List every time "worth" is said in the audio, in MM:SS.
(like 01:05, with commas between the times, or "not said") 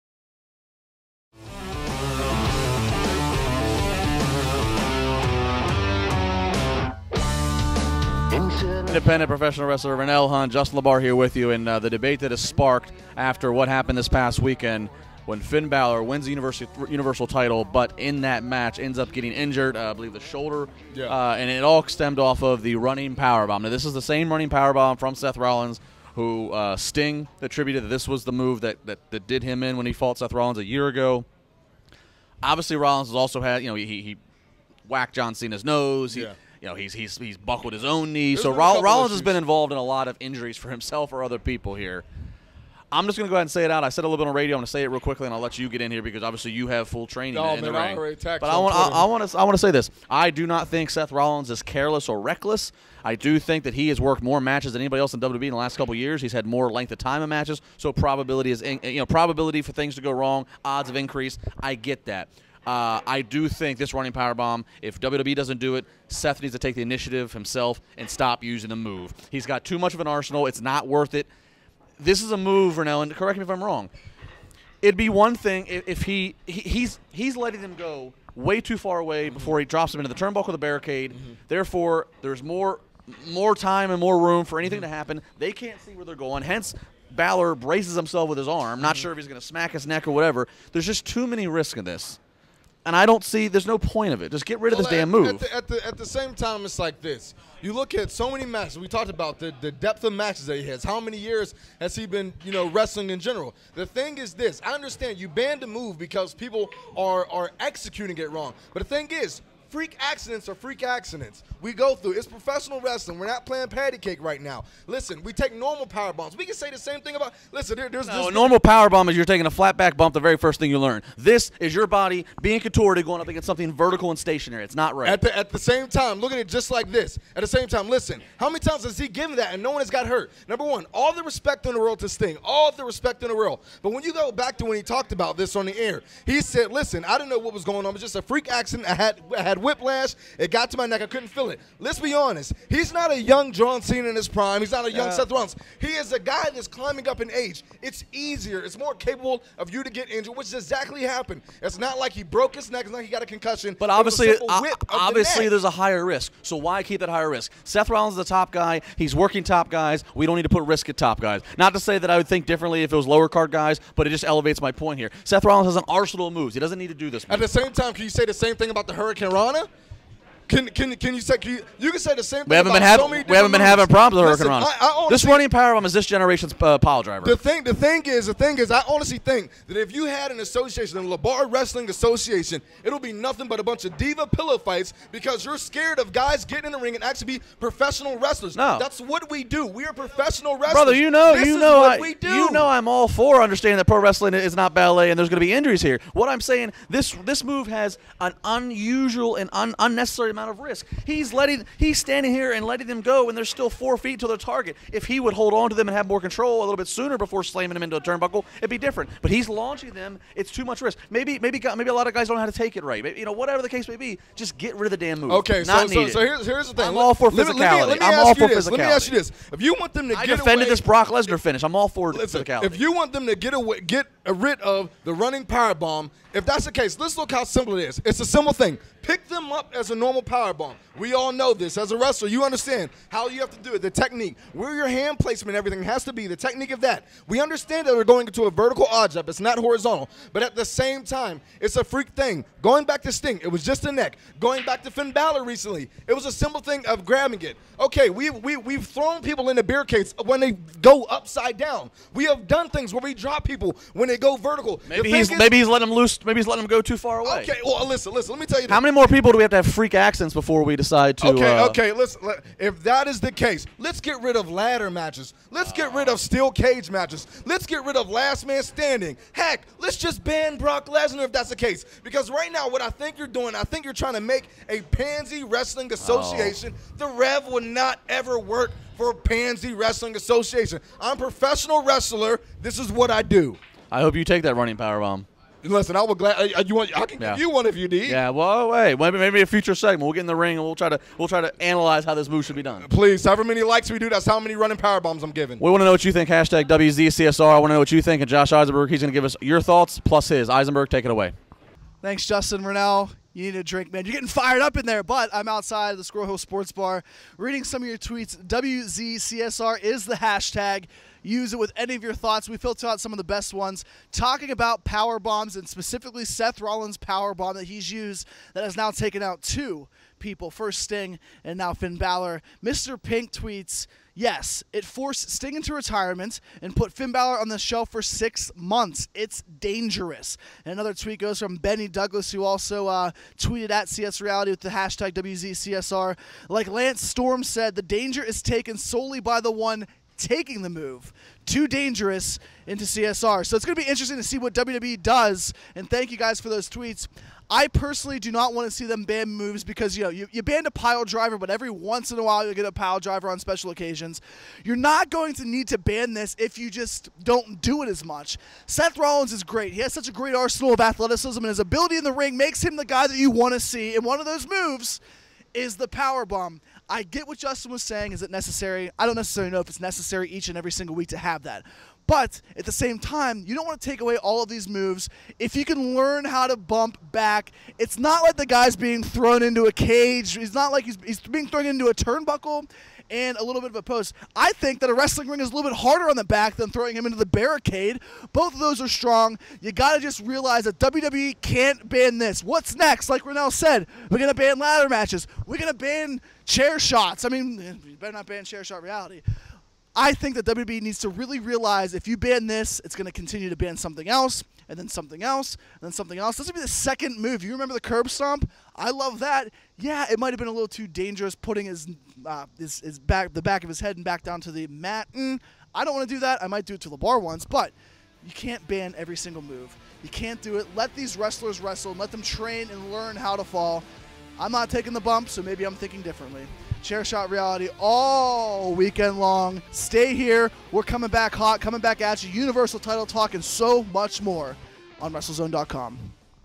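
01:10.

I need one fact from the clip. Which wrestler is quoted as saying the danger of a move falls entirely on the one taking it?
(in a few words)
Lance Storm.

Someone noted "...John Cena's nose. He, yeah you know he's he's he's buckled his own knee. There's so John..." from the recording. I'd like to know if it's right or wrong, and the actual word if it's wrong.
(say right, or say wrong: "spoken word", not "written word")
wrong: "Roll", not "John".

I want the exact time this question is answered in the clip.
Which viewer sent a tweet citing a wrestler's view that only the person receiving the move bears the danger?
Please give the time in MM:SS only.
05:31.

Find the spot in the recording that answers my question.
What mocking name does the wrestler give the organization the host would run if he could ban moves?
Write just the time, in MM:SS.
03:01.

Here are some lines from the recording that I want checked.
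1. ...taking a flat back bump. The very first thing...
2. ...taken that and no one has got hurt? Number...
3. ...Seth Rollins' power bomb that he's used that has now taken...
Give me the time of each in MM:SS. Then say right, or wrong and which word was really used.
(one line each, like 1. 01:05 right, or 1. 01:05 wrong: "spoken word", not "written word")
1. 01:59 right
2. 02:09 wrong: "given", not "taken"
3. 05:16 right.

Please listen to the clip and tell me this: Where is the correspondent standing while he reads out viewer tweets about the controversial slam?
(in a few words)
Squirrel Hill Sports Bar.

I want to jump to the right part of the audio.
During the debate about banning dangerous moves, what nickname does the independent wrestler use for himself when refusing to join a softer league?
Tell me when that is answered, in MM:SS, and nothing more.
04:36.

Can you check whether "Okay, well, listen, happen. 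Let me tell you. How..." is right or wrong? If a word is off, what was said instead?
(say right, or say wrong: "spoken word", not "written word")
wrong: "listen", not "happen".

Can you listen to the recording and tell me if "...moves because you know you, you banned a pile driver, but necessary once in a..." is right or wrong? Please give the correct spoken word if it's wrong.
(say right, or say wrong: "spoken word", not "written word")
wrong: "every", not "necessary".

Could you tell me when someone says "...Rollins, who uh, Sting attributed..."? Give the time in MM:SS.
00:25.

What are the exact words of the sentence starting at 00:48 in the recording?
But I want, I, I want to, I want to say this.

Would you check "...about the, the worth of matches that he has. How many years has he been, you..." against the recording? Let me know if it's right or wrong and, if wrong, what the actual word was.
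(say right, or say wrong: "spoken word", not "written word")
wrong: "depth", not "worth".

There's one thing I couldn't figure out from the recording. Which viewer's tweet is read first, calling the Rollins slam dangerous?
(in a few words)
Mr. Pink.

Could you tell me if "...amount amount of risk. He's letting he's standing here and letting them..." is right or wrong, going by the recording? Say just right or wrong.
right.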